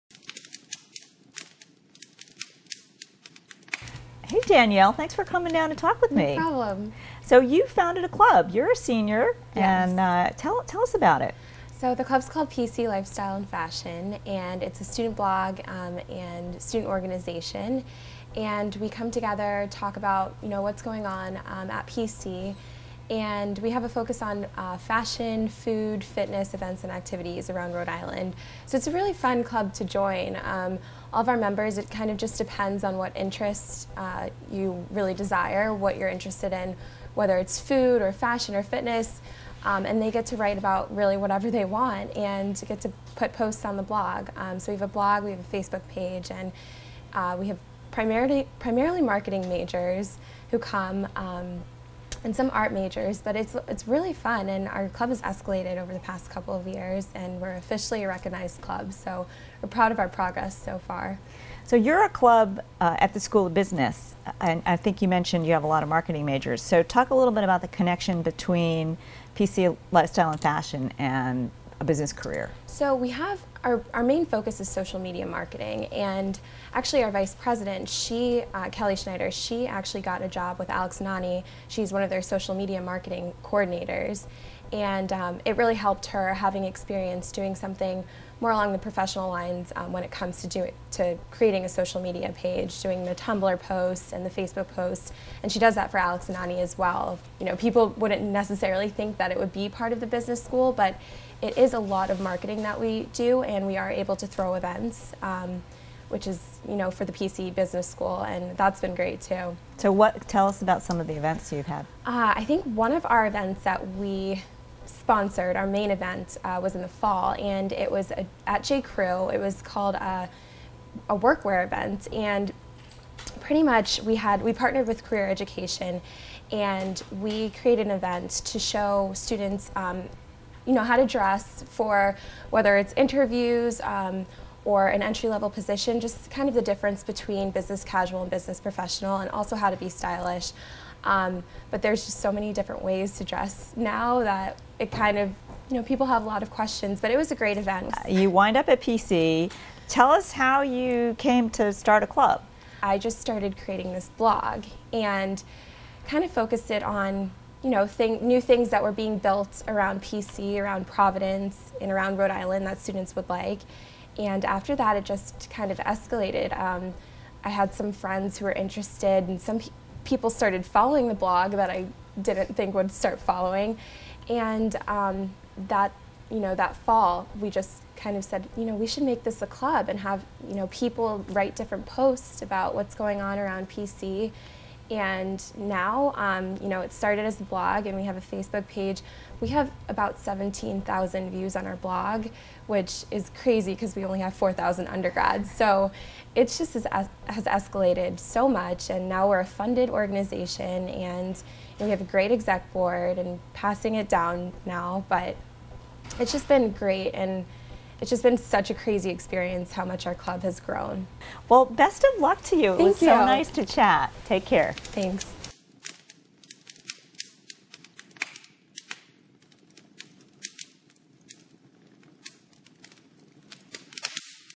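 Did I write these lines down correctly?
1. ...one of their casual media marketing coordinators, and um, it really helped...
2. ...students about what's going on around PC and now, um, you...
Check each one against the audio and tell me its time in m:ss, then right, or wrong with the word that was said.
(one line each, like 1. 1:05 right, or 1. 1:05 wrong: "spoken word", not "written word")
1. 1:21 wrong: "social", not "casual"
2. 3:01 wrong: "posts", not "students".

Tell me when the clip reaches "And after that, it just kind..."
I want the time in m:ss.
2:44.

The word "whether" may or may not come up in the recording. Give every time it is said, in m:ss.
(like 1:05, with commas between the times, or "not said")
0:37, 2:12.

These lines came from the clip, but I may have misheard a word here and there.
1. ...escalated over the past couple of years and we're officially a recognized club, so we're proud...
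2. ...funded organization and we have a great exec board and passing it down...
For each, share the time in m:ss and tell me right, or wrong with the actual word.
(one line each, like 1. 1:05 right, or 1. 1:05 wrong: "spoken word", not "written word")
1. 0:55 right
2. 3:19 right.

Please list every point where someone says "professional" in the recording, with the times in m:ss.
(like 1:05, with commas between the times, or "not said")
1:28, 2:18.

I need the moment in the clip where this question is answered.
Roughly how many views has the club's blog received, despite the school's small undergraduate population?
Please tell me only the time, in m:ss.
3:10.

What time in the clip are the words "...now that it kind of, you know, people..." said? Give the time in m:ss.
2:23.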